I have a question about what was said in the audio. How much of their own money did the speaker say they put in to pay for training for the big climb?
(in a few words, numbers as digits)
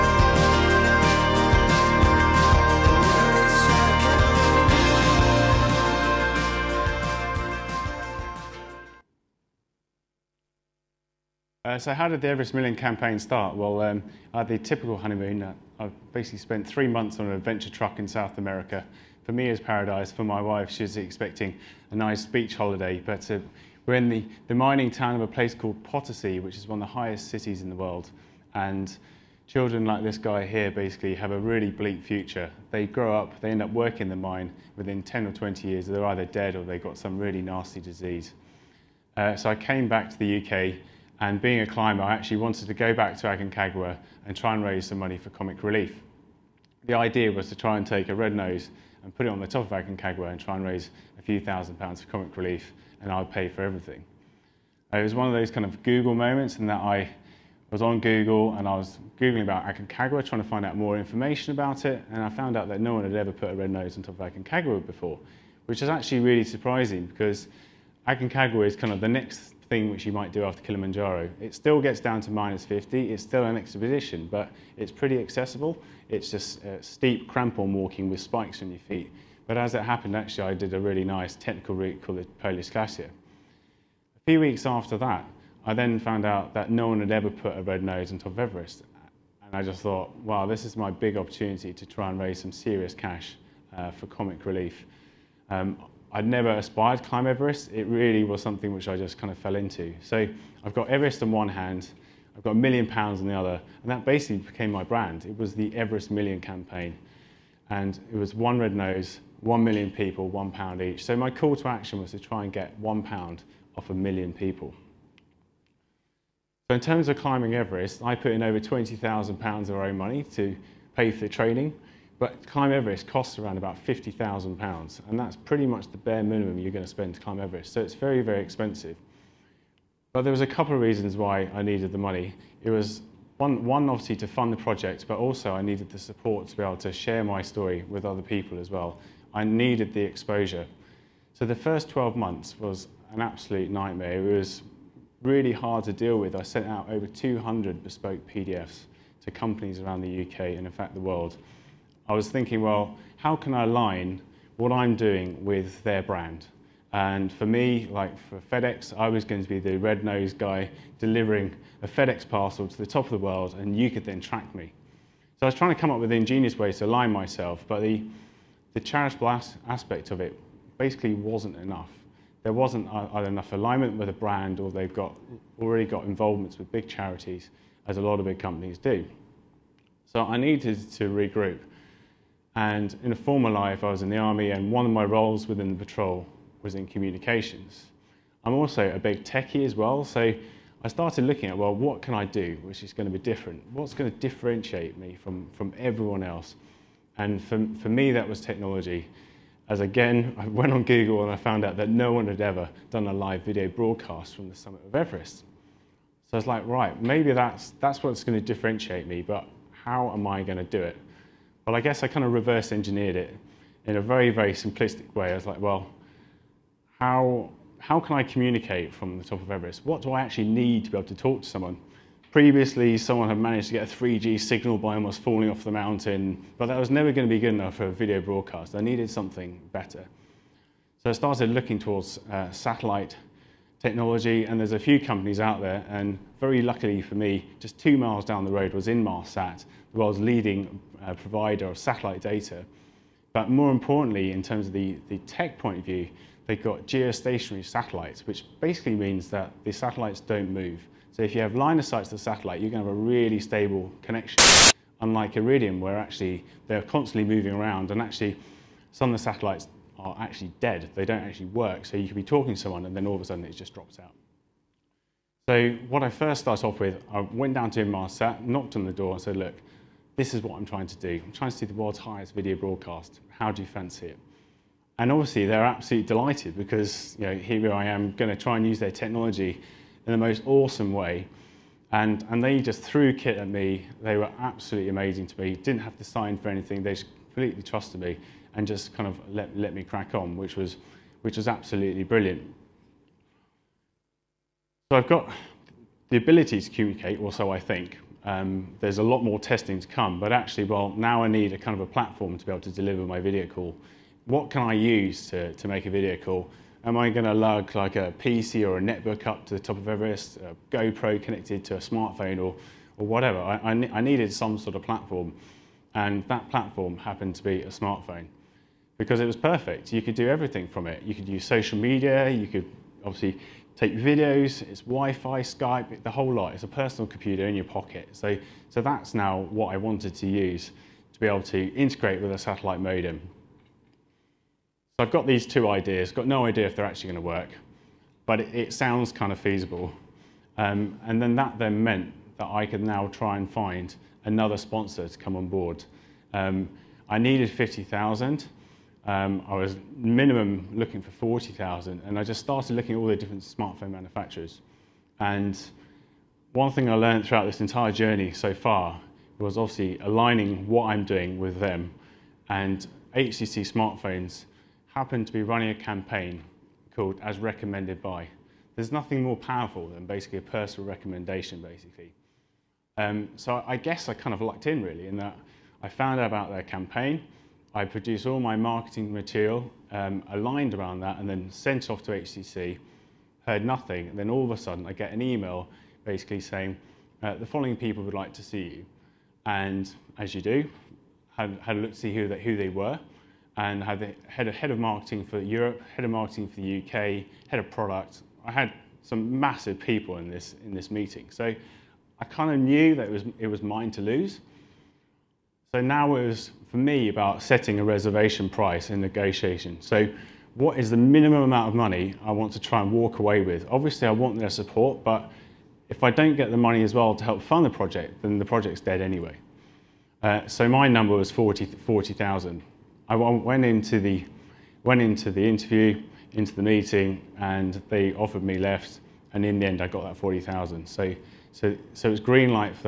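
£20,000.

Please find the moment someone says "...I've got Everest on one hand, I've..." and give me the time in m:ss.
1:40.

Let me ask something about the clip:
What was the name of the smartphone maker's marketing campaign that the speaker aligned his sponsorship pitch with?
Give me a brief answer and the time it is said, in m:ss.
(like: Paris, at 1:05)
As Recommended By, at 6:07.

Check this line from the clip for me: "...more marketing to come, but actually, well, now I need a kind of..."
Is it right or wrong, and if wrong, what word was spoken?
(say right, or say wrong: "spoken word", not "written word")
wrong: "testing", not "marketing".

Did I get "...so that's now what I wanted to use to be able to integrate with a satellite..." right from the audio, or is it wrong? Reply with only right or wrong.
right.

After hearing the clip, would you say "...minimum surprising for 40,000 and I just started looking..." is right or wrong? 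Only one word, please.
wrong.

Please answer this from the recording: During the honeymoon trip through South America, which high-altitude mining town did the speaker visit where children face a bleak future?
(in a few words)
Potosi.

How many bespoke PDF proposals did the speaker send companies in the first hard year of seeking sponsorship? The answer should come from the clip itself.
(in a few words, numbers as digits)
over 200.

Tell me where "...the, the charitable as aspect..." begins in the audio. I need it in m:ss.
2:47.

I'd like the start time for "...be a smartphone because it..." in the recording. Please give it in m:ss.
5:17.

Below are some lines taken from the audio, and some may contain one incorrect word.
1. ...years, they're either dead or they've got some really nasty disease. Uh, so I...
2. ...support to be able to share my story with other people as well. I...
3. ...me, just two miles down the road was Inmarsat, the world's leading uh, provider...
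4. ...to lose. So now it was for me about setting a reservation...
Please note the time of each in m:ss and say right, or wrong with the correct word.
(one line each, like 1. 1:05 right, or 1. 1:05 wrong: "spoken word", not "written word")
1. 0:35 right
2. 2:15 right
3. 3:57 right
4. 6:43 right.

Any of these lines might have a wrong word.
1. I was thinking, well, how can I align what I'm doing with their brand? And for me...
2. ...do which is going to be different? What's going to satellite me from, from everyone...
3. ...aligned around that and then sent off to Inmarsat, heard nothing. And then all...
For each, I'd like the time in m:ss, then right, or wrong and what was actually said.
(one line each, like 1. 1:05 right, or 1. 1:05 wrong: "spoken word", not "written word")
1. 2:32 right
2. 3:12 wrong: "differentiate", not "satellite"
3. 6:20 wrong: "HTC", not "Inmarsat".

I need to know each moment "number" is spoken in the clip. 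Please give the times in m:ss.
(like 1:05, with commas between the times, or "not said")
7:00.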